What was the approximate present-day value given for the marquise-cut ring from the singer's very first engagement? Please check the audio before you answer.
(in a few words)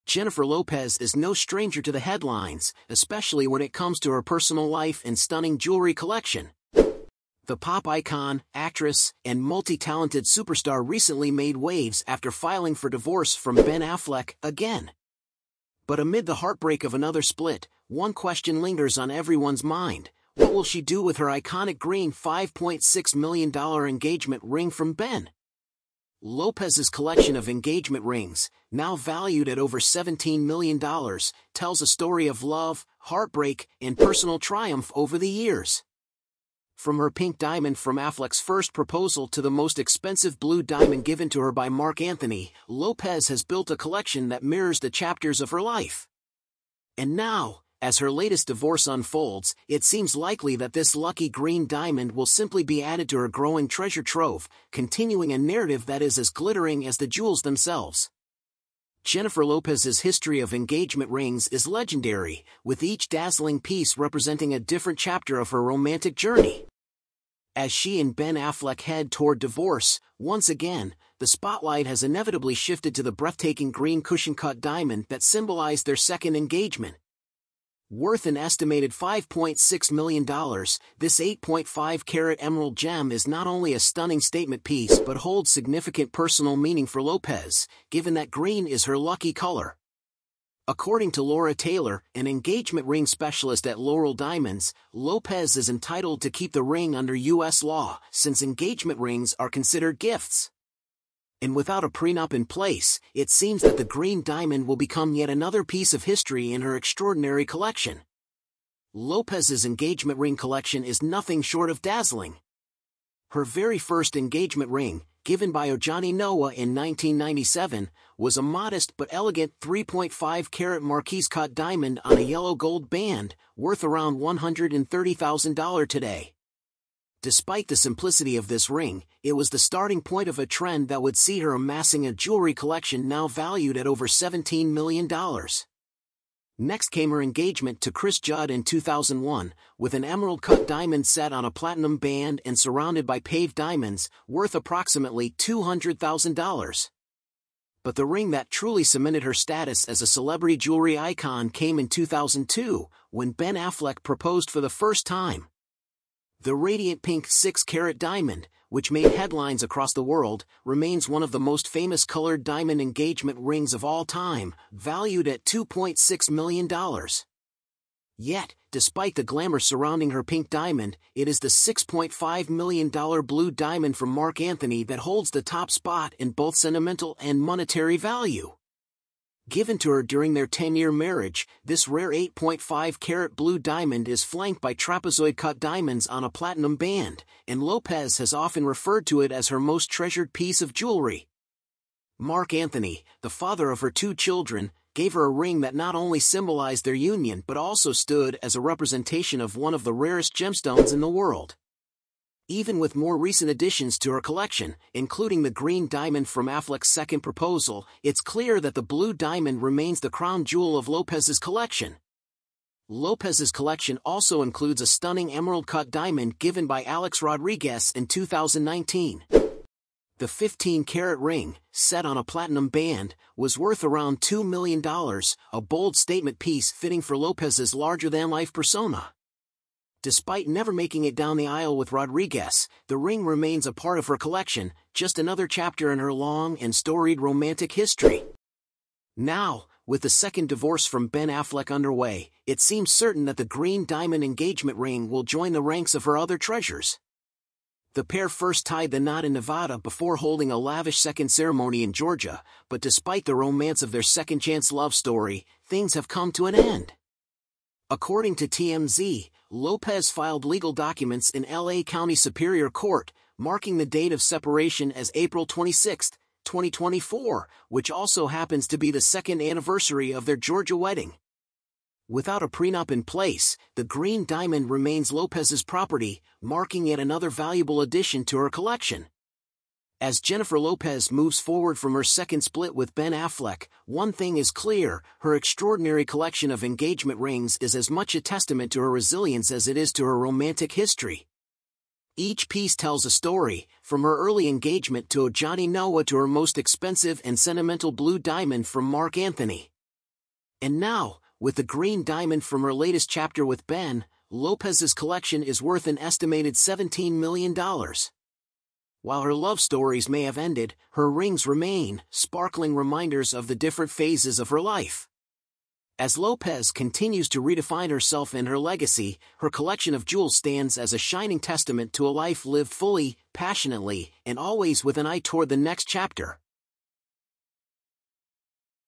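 $130,000.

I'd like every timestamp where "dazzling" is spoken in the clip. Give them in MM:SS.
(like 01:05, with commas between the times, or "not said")
01:03, 01:51.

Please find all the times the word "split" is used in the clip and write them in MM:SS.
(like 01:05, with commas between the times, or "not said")
00:17, 04:42.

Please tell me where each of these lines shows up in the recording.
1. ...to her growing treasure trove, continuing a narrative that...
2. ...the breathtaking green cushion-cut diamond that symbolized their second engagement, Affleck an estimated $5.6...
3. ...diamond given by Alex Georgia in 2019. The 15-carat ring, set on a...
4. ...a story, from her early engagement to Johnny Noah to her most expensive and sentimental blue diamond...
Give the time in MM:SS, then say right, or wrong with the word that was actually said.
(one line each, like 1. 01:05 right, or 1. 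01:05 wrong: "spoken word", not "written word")
1. 00:53 right
2. 01:13 wrong: "Worth", not "Affleck"
3. 03:35 wrong: "Rodriguez", not "Georgia"
4. 04:53 right.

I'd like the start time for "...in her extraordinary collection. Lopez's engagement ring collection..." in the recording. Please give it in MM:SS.
01:46.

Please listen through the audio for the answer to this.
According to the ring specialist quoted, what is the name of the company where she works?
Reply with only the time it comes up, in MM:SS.
01:33.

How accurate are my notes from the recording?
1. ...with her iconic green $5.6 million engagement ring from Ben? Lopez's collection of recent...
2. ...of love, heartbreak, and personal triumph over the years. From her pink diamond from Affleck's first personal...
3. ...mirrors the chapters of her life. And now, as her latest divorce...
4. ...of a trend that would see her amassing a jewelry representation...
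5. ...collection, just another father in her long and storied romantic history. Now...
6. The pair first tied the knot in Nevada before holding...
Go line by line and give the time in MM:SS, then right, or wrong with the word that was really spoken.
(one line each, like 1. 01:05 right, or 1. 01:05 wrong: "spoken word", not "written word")
1. 00:21 wrong: "engagement", not "recent"
2. 00:32 wrong: "proposal", not "personal"
3. 00:44 right
4. 02:10 wrong: "collection", not "representation"
5. 03:54 wrong: "chapter", not "father"
6. 04:07 right.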